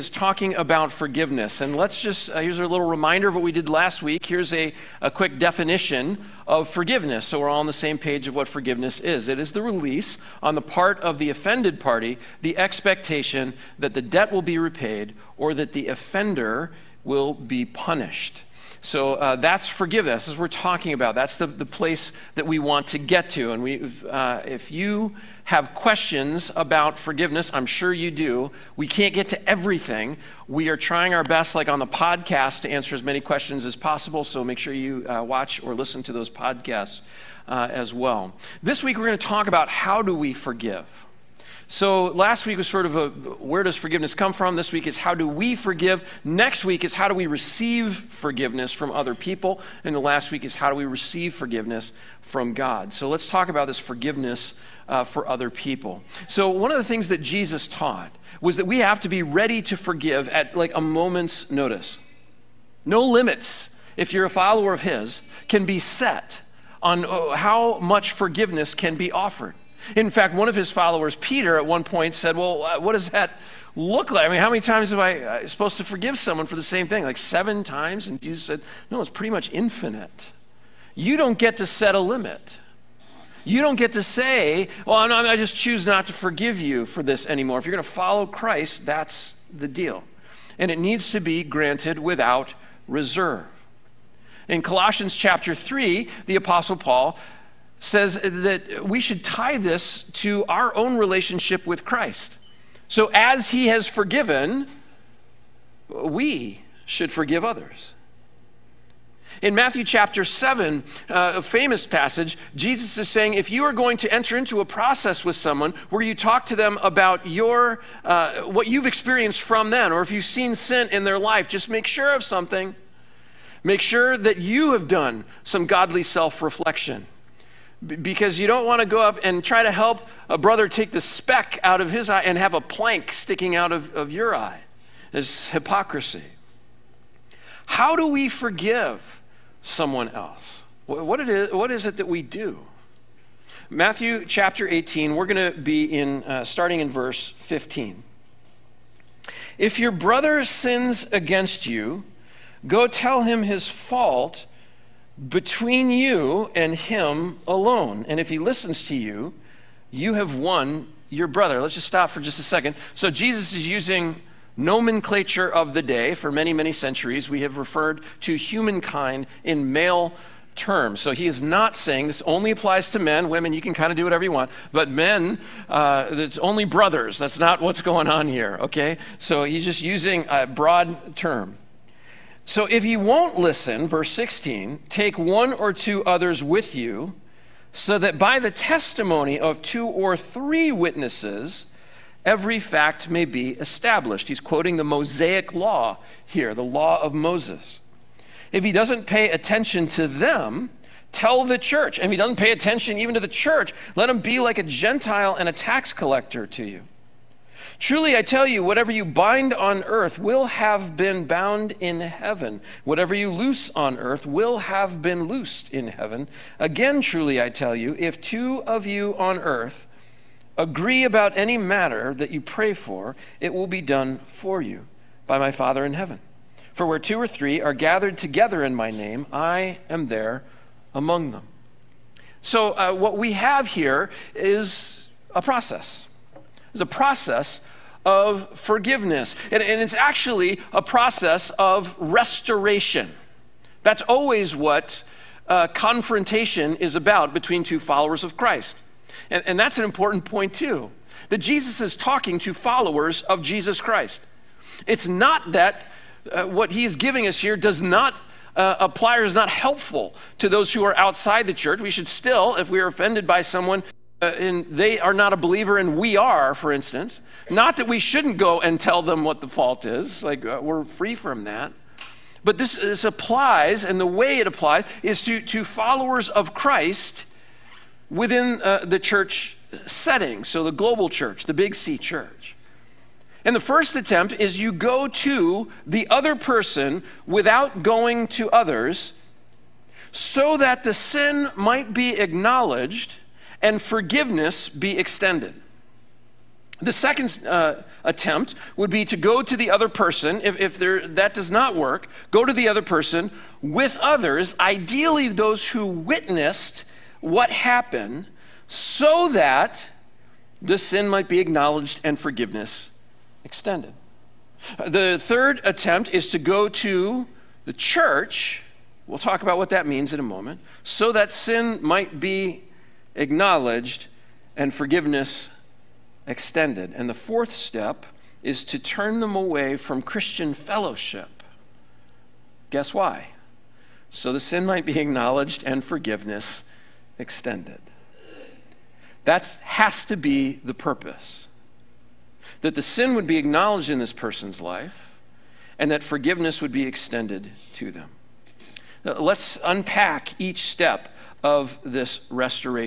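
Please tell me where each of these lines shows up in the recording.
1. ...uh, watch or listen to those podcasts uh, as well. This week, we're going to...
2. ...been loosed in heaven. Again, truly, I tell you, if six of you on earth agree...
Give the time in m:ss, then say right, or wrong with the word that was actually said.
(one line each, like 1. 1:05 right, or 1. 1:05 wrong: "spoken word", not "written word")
1. 0:35 right
2. 3:35 wrong: "two", not "six".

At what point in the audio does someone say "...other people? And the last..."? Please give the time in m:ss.
0:48.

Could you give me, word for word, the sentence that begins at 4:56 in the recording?
The second uh, attempt would be to go to the other person.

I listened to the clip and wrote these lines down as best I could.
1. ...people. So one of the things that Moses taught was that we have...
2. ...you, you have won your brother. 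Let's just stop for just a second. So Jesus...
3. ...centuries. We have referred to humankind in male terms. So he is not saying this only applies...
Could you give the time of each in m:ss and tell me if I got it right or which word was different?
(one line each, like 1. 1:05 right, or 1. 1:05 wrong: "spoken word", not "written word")
1. 0:55 wrong: "Jesus", not "Moses"
2. 2:38 right
3. 2:46 right.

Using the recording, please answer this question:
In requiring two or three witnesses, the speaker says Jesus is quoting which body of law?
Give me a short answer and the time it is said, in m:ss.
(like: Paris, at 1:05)
the law of Moses, at 3:16.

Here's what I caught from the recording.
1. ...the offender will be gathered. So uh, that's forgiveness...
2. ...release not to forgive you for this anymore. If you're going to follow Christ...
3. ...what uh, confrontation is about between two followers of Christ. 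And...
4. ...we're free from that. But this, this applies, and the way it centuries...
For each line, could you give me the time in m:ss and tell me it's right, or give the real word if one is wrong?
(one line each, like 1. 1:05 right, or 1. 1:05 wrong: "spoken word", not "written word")
1. 0:15 wrong: "punished", not "gathered"
2. 1:25 wrong: "choose", not "release"
3. 4:04 right
4. 4:30 wrong: "applies", not "centuries".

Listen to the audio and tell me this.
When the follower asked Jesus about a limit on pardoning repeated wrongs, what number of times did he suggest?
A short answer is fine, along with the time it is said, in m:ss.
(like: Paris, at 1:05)
7, at 1:17.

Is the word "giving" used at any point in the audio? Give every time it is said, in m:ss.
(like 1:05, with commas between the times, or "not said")
4:16.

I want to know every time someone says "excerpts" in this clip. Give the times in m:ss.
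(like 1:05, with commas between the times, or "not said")
not said.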